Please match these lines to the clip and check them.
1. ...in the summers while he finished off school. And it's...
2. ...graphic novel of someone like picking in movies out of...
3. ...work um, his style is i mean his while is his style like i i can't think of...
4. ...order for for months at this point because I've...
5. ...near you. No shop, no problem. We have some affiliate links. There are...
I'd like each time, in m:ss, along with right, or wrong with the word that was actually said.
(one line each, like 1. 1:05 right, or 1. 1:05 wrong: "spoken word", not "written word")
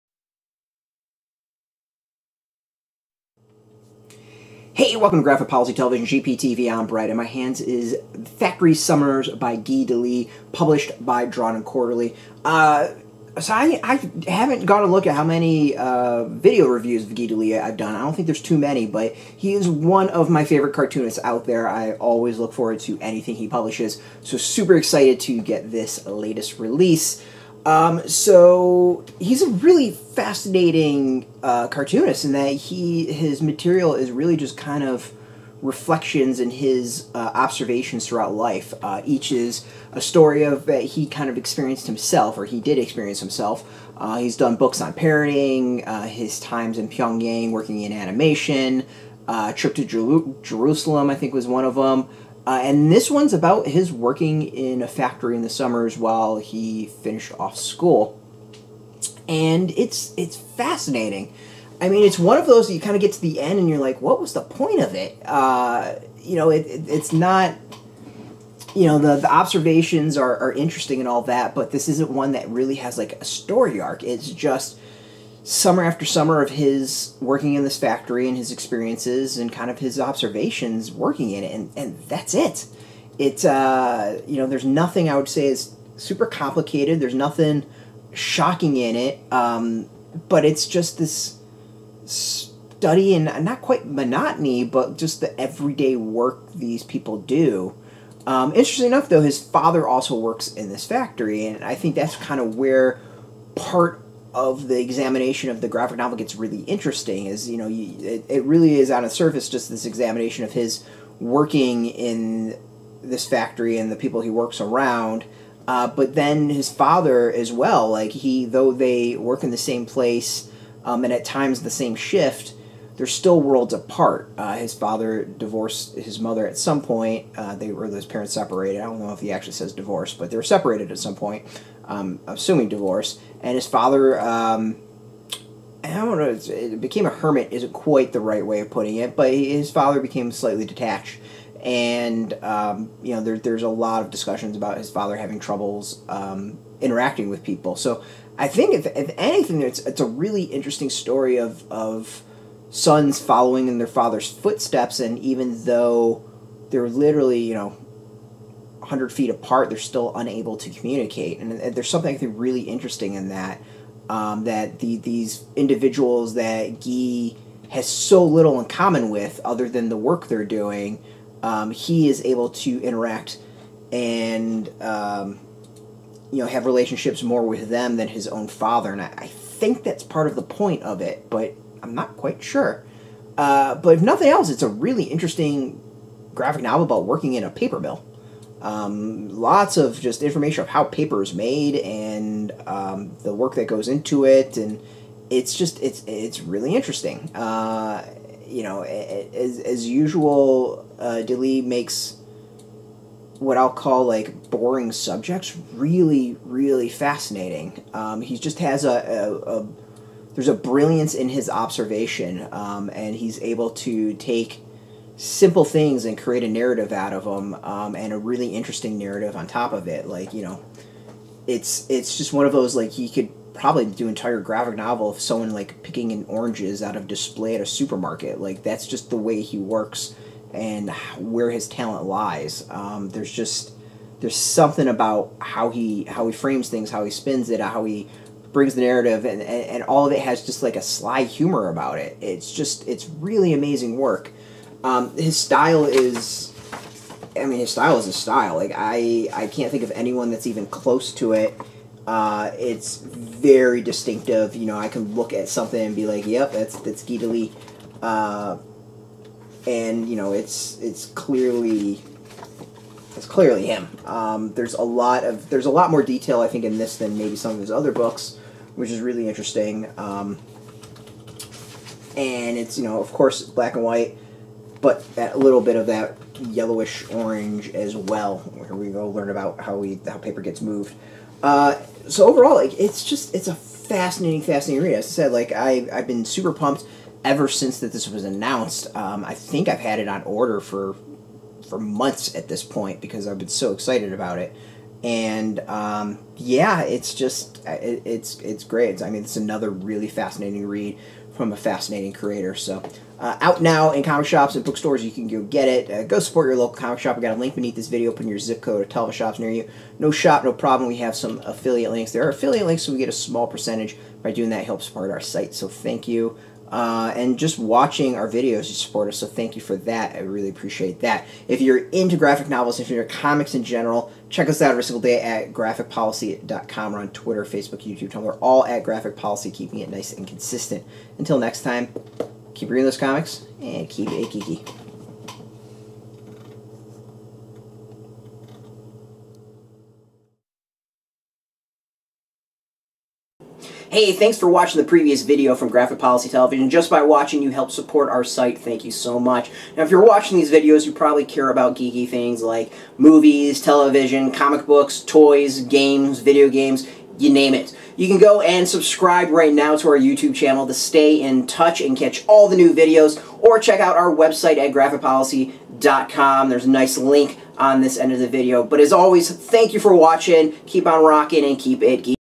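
1. 0:55 right
2. 3:44 wrong: "oranges", not "movies"
3. 4:03 wrong: "style", not "while"
4. 4:50 right
5. 5:09 right.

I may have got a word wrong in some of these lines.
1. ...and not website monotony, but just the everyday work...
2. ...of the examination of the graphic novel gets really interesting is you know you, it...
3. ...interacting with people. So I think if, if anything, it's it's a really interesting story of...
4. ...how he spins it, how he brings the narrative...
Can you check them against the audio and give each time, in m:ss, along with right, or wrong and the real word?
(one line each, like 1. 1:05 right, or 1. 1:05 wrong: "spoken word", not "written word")
1. 1:33 wrong: "quite", not "website"
2. 1:44 right
3. 2:26 right
4. 3:56 right.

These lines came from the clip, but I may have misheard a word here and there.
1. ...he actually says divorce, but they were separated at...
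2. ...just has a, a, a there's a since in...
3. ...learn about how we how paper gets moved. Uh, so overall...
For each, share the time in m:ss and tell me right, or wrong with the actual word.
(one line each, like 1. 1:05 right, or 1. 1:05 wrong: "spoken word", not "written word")
1. 2:09 right
2. 3:28 wrong: "brilliance", not "since"
3. 4:39 right.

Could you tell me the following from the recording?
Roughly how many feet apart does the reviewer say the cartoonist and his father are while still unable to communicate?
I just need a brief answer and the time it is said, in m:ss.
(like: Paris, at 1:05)
100, at 2:38.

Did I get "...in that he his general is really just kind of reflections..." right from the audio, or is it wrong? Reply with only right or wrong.
wrong.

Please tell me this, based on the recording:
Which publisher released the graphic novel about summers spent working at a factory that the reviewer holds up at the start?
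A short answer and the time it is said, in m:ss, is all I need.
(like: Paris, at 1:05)
Drawn and Quarterly, at 0:11.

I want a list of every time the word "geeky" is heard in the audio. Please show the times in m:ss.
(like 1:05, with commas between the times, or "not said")
5:34, 5:51, 6:12.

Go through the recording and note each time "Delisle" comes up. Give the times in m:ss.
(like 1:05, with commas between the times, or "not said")
0:09, 0:17, 3:21.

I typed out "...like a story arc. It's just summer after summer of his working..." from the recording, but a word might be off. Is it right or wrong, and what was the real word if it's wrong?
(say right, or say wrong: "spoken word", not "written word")
right.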